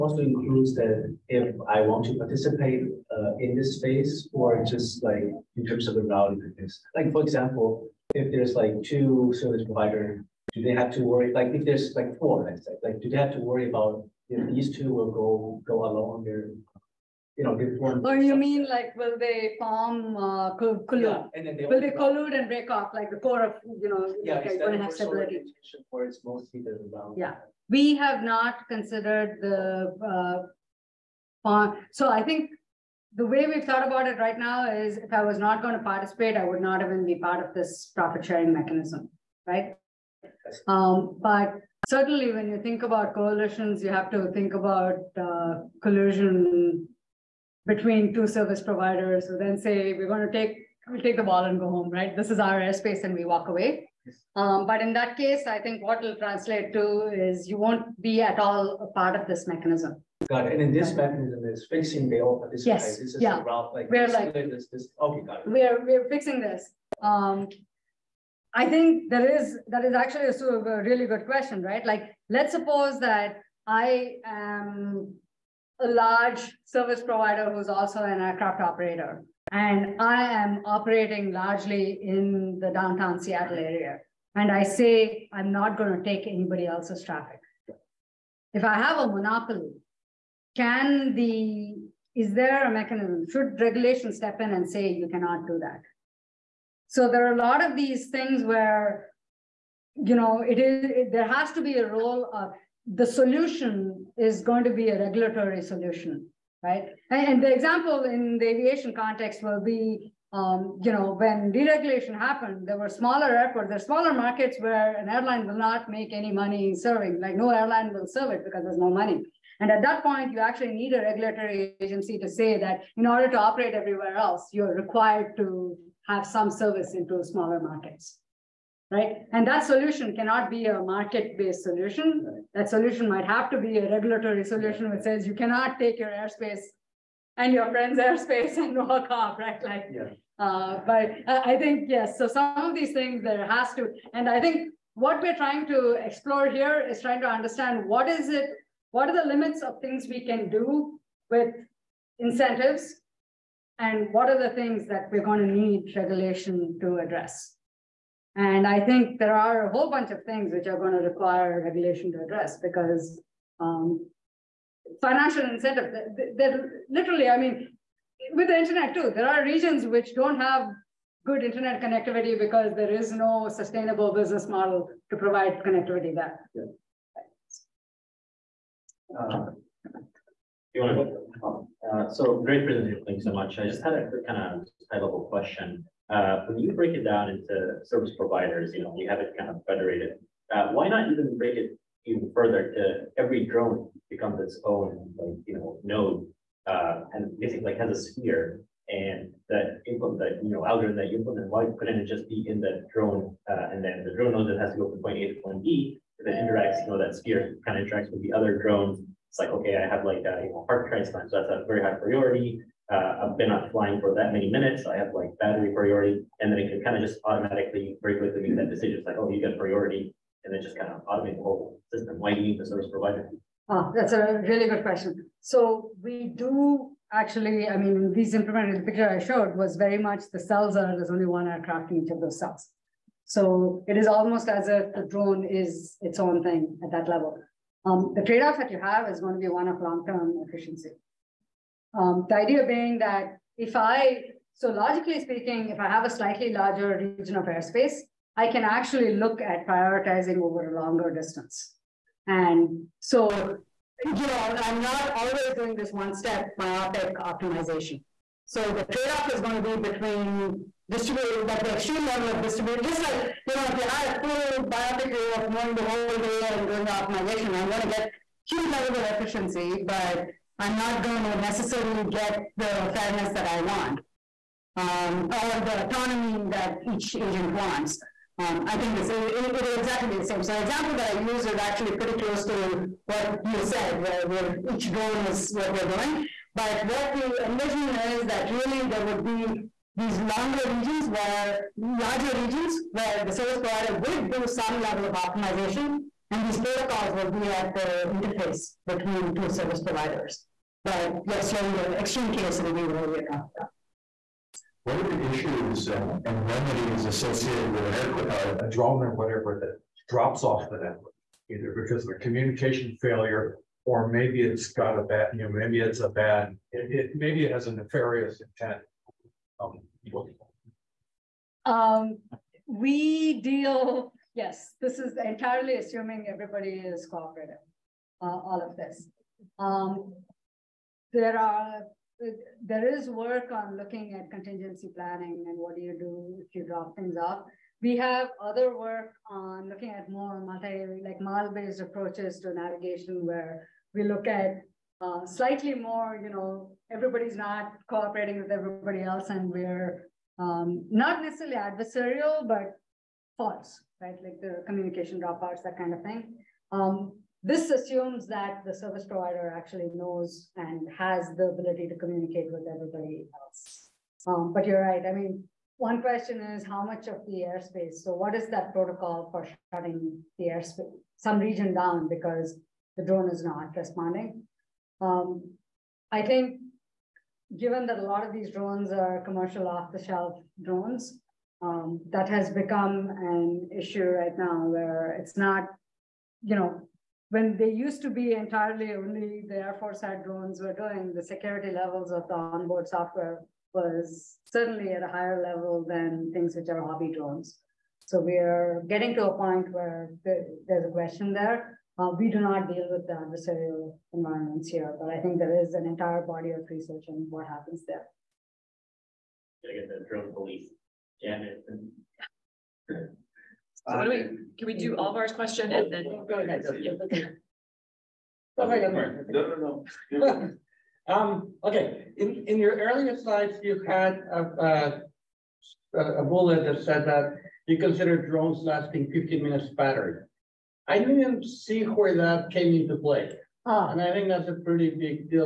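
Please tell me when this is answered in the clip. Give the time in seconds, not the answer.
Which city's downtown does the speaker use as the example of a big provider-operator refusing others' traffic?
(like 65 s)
82 s.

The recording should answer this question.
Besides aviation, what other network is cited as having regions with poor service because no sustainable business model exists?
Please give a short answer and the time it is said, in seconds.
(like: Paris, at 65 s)
the internet, at 168 s.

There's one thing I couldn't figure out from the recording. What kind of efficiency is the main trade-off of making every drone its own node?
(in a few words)
long-term efficiency.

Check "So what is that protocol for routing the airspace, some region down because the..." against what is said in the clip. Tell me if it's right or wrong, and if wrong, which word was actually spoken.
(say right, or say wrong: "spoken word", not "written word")
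wrong: "shutting", not "routing".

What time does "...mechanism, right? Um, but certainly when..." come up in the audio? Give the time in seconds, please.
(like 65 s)
38 s.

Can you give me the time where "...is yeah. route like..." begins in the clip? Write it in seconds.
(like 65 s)
63 s.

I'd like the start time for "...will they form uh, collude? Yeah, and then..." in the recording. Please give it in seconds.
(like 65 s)
18 s.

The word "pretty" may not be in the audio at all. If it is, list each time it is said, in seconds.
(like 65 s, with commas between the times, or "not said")
281 s, 434 s.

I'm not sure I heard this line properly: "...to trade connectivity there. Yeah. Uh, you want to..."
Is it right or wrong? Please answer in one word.
wrong.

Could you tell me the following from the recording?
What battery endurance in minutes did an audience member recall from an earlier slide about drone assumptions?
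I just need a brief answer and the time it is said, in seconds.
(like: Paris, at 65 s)
15 minutes, at 429 s.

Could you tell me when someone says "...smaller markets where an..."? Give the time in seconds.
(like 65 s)
113 s.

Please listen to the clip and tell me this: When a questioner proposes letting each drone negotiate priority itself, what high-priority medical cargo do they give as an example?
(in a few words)
heart transplant.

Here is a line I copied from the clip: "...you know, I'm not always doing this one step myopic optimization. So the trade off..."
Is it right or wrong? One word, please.
right.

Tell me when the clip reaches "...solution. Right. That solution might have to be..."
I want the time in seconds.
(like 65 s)
131 s.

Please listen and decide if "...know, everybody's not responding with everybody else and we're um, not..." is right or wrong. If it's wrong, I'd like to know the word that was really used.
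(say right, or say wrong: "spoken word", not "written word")
wrong: "cooperating", not "responding".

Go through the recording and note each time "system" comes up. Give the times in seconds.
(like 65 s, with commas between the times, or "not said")
221 s.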